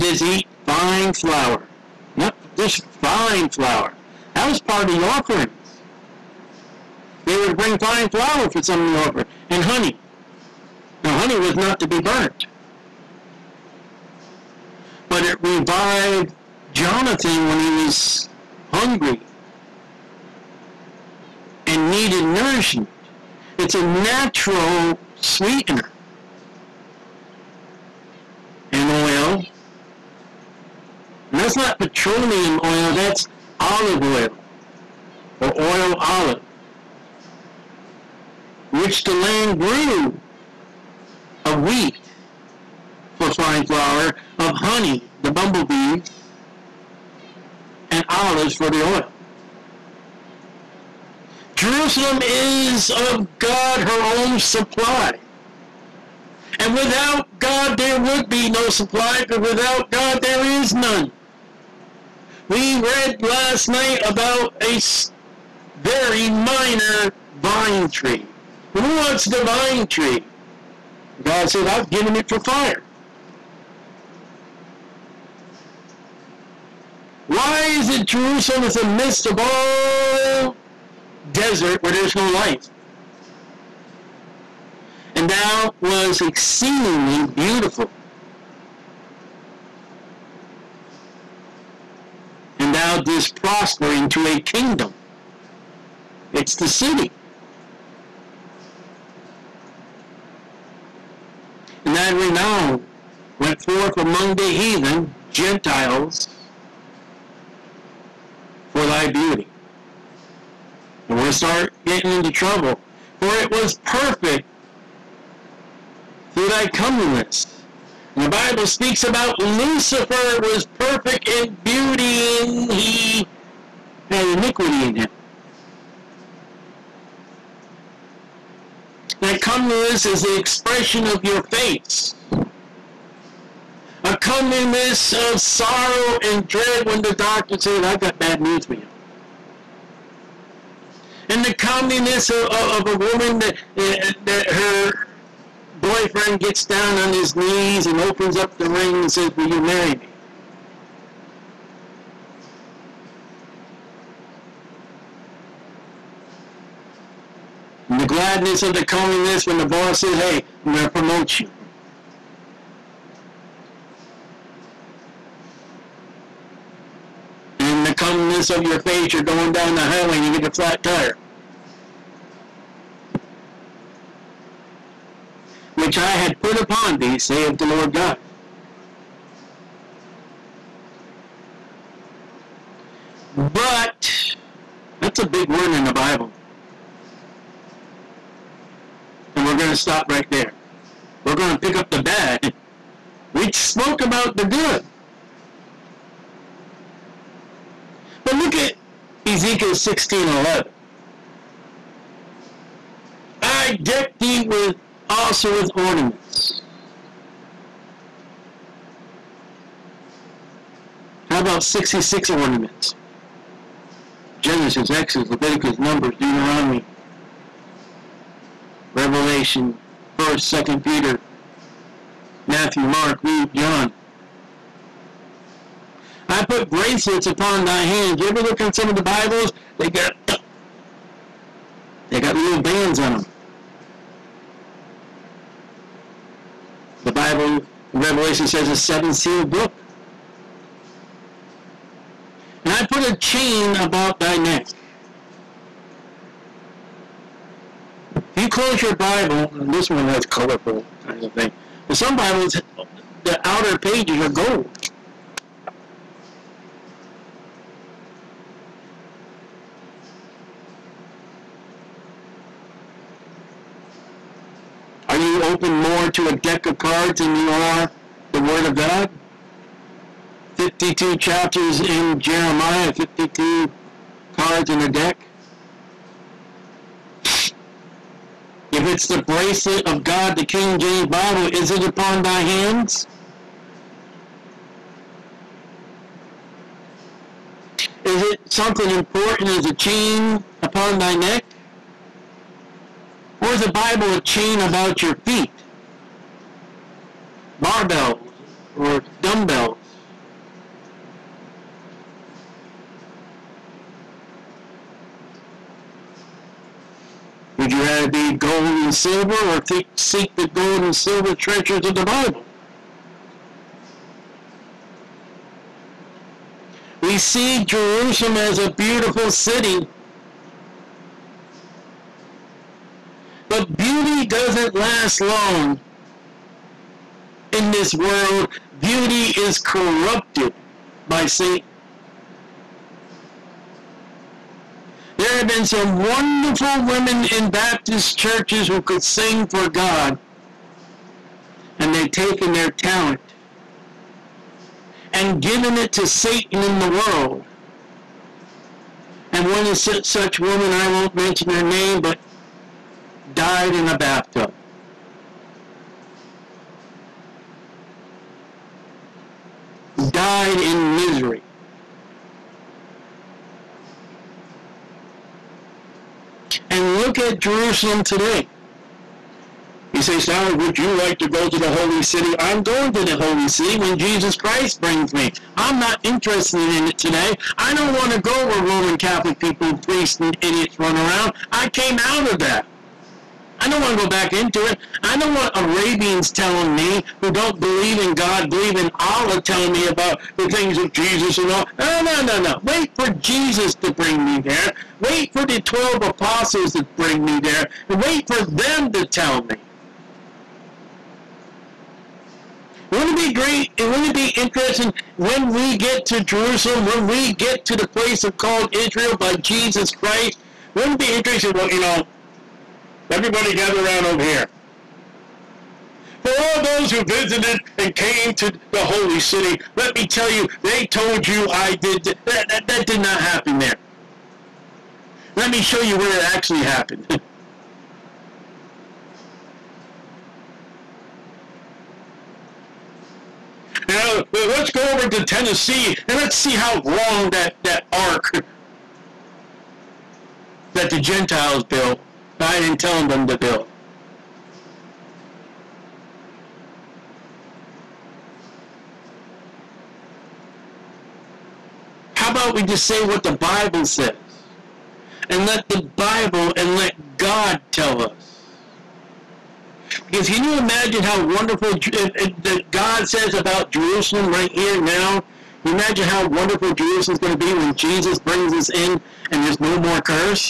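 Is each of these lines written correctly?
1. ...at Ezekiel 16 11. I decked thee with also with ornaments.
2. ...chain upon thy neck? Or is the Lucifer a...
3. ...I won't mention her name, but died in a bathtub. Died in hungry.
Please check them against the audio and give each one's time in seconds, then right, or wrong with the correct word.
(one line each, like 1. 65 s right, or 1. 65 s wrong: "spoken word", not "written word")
1. 198 s right
2. 289 s wrong: "Bible", not "Lucifer"
3. 350 s wrong: "misery", not "hungry".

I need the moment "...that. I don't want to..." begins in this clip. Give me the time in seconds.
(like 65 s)
382 s.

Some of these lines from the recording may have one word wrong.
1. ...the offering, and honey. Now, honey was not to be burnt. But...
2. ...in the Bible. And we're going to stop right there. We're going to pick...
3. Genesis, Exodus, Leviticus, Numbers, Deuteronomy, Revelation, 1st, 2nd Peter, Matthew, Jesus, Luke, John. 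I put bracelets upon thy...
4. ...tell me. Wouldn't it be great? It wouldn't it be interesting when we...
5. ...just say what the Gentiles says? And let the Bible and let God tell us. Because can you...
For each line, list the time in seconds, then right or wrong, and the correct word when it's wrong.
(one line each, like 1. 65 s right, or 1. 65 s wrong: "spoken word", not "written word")
1. 8 s right
2. 185 s right
3. 214 s wrong: "Mark", not "Jesus"
4. 399 s right
5. 452 s wrong: "Bible", not "Gentiles".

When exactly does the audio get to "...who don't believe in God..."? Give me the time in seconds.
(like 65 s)
387 s.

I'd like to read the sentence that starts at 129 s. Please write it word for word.
That comeliness is the expression of your face.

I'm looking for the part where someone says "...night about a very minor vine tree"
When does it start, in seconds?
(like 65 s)
63 s.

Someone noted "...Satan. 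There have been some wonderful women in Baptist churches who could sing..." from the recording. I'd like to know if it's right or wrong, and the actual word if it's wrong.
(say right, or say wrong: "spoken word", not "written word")
right.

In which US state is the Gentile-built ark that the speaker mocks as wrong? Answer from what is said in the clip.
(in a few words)
Tennessee.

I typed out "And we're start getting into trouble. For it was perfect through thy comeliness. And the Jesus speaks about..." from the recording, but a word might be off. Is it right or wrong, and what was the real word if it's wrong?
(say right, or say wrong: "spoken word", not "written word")
wrong: "Bible", not "Jesus".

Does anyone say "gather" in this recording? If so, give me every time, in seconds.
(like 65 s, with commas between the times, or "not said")
413 s.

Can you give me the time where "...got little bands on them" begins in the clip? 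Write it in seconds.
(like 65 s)
232 s.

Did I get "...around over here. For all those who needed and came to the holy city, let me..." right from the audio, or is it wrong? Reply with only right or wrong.
wrong.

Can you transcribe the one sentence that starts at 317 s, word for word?
We see Jerusalem as a beautiful city But beauty doesn't last long in this world.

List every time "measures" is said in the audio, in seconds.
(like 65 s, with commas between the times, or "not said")
not said.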